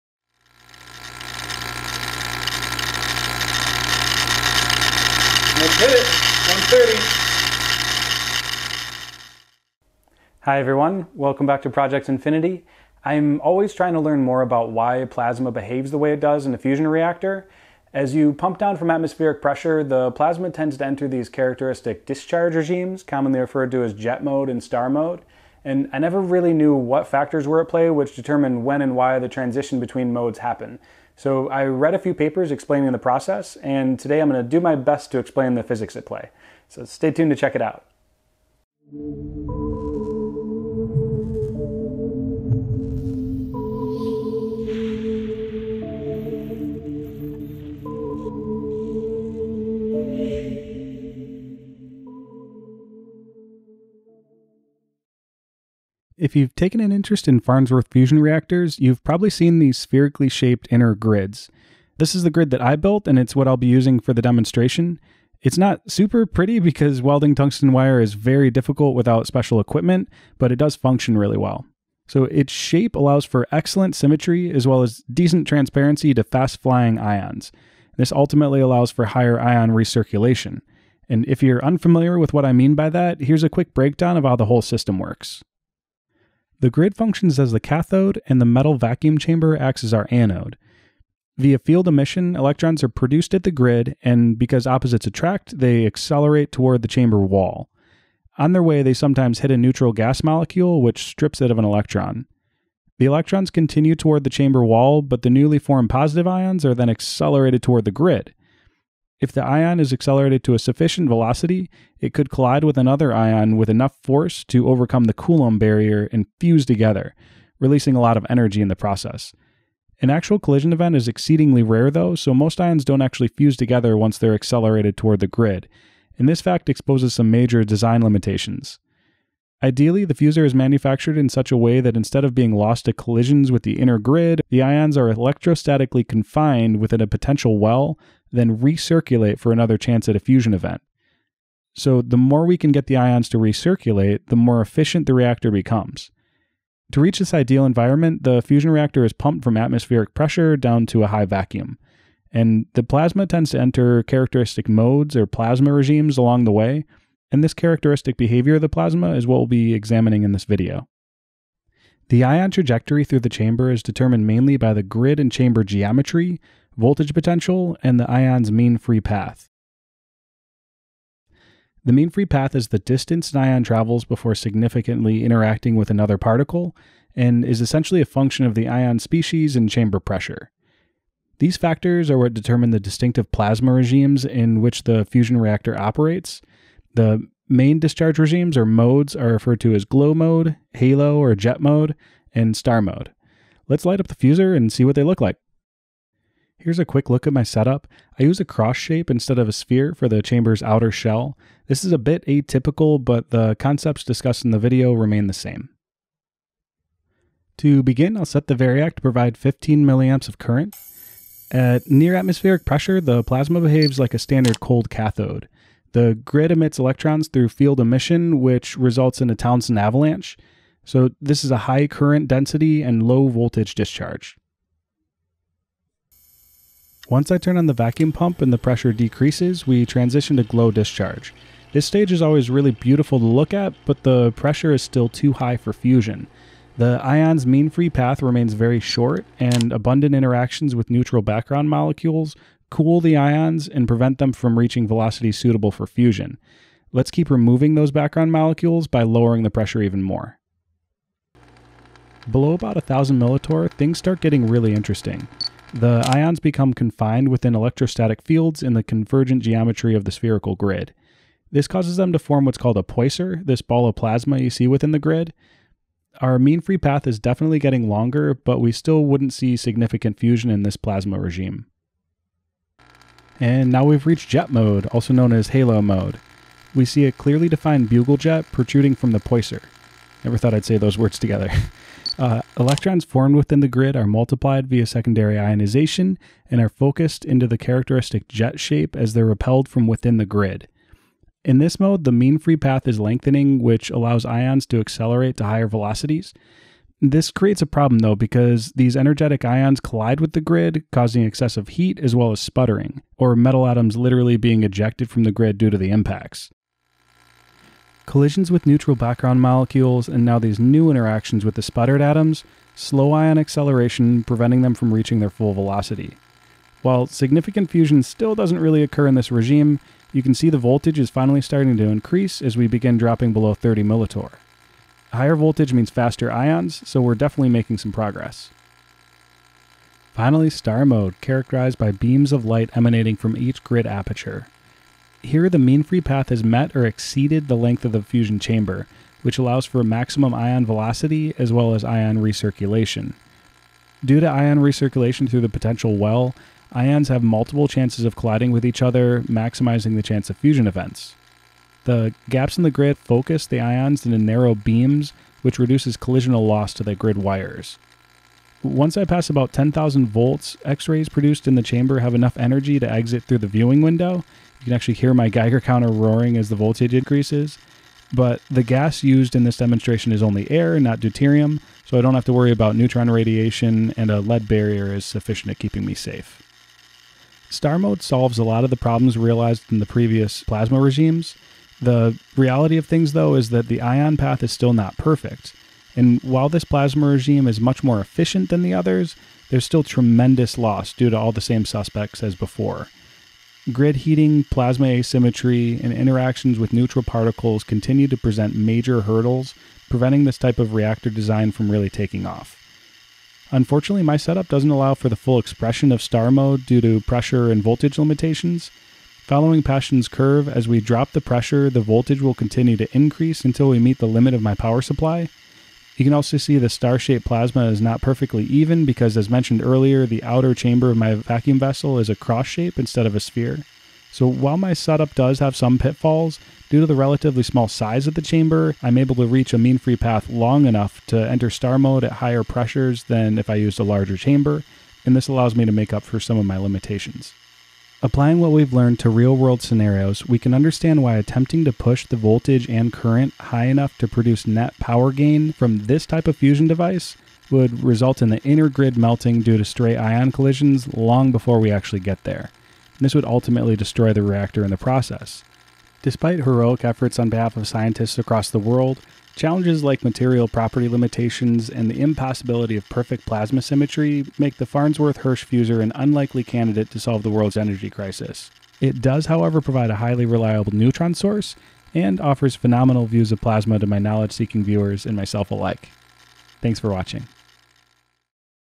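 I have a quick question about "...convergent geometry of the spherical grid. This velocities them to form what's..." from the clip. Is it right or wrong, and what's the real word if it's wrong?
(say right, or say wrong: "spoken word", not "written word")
wrong: "causes", not "velocities".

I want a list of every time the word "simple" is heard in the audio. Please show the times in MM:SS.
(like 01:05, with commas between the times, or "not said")
not said.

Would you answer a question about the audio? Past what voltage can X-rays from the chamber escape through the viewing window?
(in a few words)
10,000 volts.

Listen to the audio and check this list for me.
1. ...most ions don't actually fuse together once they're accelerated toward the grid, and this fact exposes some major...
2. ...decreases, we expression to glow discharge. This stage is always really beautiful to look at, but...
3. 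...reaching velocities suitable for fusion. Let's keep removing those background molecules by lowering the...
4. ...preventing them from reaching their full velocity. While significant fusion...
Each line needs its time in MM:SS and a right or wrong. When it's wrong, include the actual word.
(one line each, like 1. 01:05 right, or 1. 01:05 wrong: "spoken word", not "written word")
1. 02:02 right
2. 03:48 wrong: "transition", not "expression"
3. 04:04 right
4. 05:14 right.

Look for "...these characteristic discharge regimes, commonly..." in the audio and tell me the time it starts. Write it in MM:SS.
00:21.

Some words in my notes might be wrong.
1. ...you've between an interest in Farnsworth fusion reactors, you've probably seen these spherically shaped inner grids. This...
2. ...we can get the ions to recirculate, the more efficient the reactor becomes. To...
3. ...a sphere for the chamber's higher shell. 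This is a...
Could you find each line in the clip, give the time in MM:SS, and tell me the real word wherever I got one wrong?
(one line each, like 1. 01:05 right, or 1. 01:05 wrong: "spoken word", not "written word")
1. 00:56 wrong: "taken", not "between"
2. 02:22 right
3. 03:19 wrong: "outer", not "higher".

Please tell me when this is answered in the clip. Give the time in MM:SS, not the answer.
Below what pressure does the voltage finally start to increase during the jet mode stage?
05:23.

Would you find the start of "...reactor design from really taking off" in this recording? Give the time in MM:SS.
06:40.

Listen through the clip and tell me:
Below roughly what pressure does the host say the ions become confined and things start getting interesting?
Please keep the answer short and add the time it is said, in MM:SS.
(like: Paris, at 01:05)
1000 millitorr, at 04:12.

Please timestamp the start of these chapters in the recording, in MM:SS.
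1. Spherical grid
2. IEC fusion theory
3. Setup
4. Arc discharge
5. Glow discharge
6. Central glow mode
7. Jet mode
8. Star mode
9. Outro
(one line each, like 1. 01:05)
1. 00:55
2. 01:26
3. 03:16
4. 03:27
5. 03:46
6. 04:11
7. 04:33
8. 05:29
9. 07:17.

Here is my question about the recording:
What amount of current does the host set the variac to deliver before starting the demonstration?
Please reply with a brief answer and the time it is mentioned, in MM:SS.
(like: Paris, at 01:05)
15 milliamps, at 03:29.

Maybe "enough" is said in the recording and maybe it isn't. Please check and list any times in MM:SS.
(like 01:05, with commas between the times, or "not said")
01:53, 06:02, 07:10, 07:23.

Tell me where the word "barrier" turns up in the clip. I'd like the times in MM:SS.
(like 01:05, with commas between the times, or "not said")
01:55, 06:14.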